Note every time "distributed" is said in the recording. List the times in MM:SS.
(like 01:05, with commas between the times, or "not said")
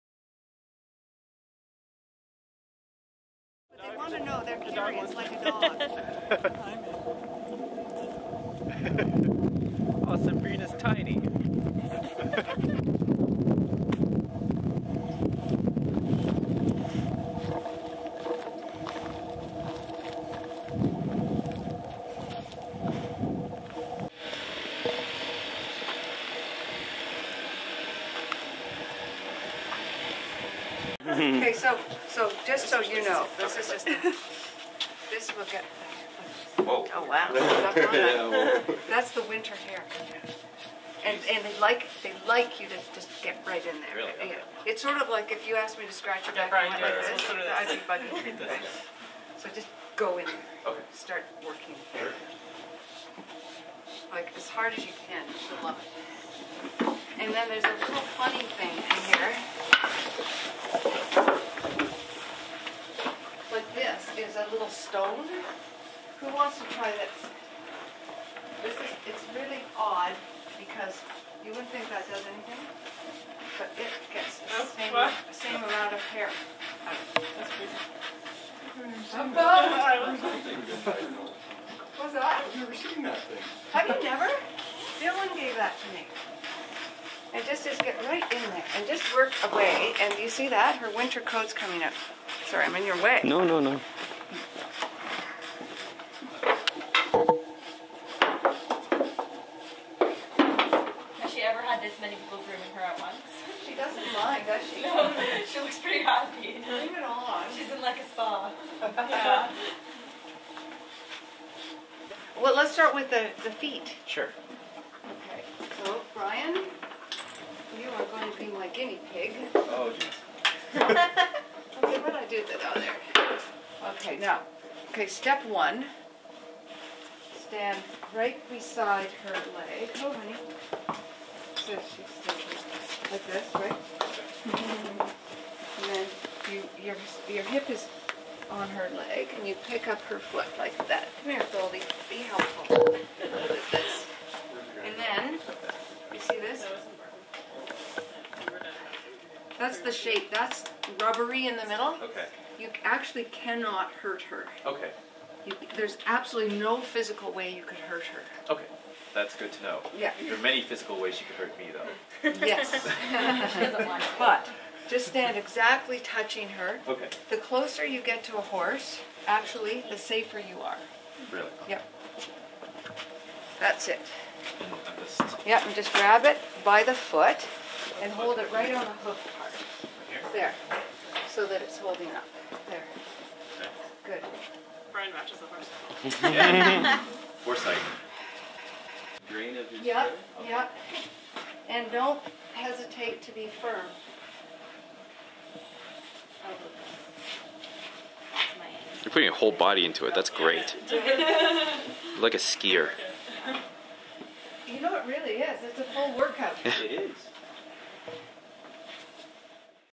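not said.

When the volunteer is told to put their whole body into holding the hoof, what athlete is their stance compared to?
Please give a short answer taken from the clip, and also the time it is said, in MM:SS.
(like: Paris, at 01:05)
a skier, at 03:22.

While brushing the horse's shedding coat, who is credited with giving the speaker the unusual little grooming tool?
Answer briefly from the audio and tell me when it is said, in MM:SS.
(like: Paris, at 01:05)
Dylan, at 01:24.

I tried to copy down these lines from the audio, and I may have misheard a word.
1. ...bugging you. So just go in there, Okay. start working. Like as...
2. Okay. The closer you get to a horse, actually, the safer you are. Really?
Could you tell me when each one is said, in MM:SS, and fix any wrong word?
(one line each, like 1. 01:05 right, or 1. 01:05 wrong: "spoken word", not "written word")
1. 00:47 right
2. 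02:46 right.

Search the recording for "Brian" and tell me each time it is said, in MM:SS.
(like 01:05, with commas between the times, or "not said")
01:56, 03:04.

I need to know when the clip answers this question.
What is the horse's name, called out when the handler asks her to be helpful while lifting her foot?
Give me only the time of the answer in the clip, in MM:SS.
02:21.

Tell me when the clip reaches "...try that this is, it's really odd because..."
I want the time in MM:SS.
01:06.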